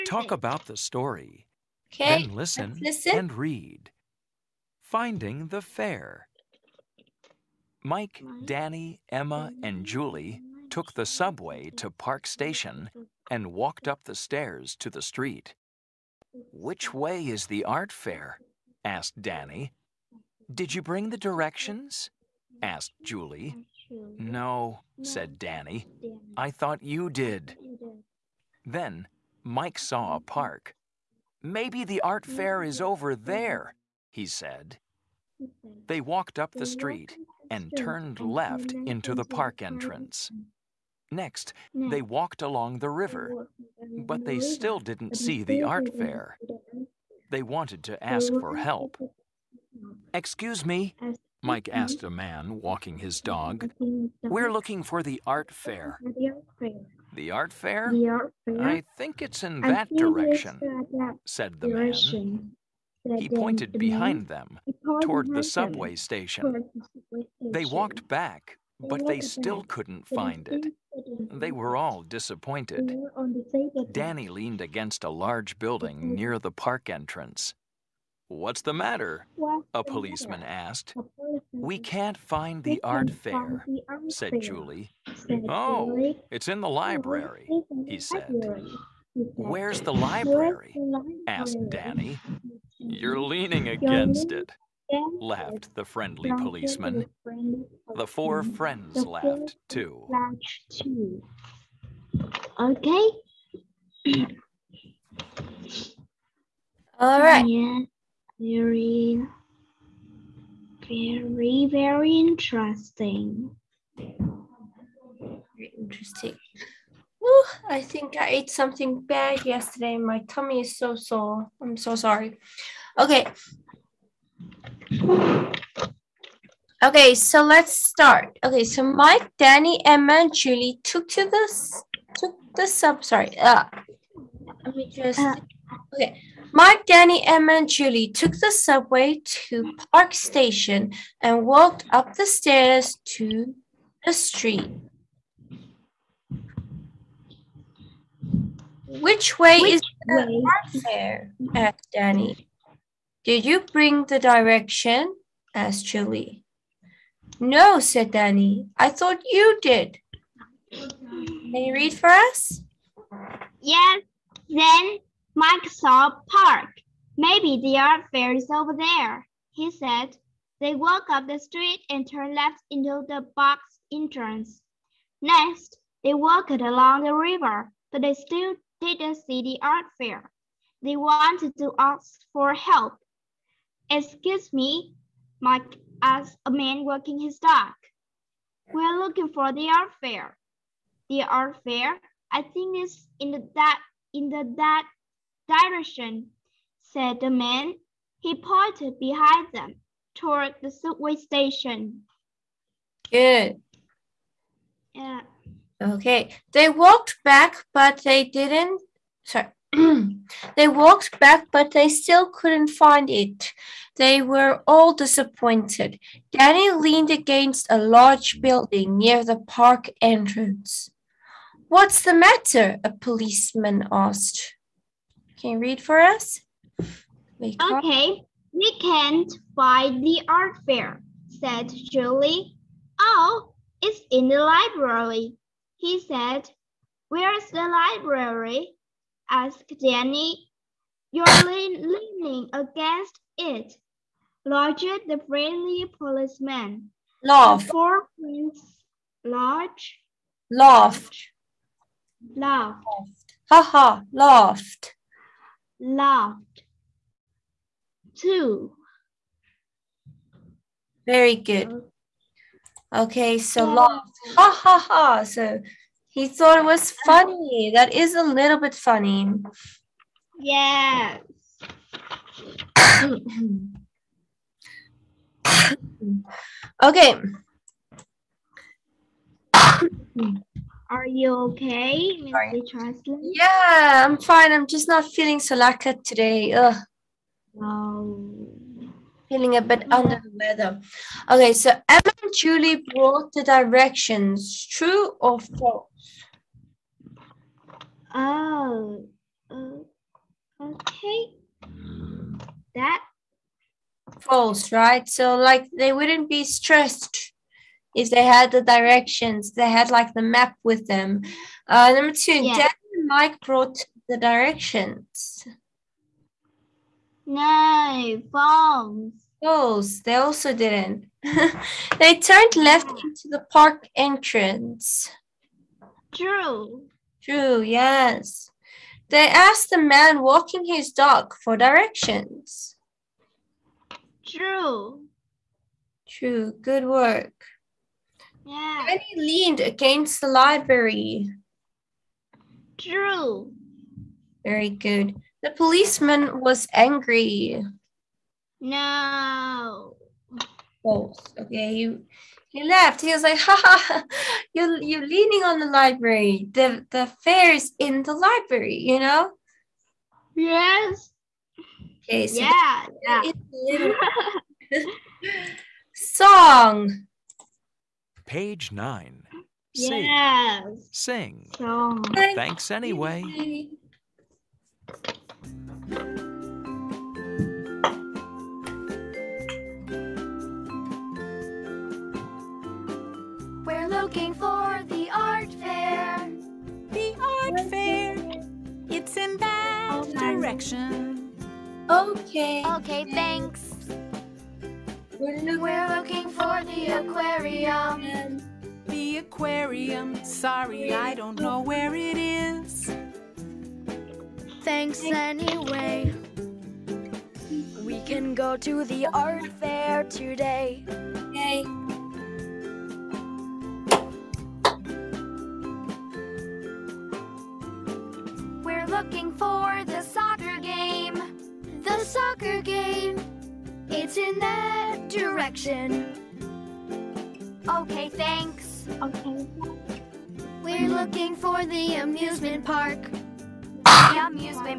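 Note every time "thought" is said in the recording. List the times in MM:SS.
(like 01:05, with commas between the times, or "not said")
00:26, 02:38, 04:26.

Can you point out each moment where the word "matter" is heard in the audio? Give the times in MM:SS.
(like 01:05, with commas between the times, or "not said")
01:18, 03:42.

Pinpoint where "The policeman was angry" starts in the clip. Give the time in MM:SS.
05:45.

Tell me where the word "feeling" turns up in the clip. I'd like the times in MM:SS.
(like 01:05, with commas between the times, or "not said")
04:45, 04:49.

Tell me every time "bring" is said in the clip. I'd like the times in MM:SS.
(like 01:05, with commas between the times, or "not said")
00:20, 02:33.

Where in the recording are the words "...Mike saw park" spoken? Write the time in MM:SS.
02:45.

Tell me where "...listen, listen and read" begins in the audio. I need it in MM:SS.
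00:02.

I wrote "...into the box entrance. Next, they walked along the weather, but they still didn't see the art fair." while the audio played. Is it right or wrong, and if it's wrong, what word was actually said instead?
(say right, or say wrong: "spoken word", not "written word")
wrong: "river", not "weather".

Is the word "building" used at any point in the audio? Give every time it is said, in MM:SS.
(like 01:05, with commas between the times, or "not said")
01:15, 03:38.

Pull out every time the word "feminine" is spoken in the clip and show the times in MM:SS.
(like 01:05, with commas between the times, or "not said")
not said.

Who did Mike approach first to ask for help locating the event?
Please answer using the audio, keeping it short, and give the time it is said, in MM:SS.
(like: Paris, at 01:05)
A man walking his dog, at 00:52.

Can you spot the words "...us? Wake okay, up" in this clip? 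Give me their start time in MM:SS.
03:45.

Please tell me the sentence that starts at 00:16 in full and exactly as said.
Which way is the art fair?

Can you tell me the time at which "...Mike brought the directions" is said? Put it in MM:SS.
05:13.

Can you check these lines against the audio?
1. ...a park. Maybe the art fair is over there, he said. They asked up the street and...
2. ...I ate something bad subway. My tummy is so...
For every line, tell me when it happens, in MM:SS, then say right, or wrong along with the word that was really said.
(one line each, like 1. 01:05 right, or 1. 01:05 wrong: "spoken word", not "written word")
1. 00:30 wrong: "walked", not "asked"
2. 01:58 wrong: "yesterday", not "subway".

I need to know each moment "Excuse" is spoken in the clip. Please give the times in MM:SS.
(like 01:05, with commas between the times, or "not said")
00:50, 03:03.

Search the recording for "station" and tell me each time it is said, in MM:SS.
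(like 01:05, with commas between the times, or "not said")
00:12, 01:05, 02:20, 03:21.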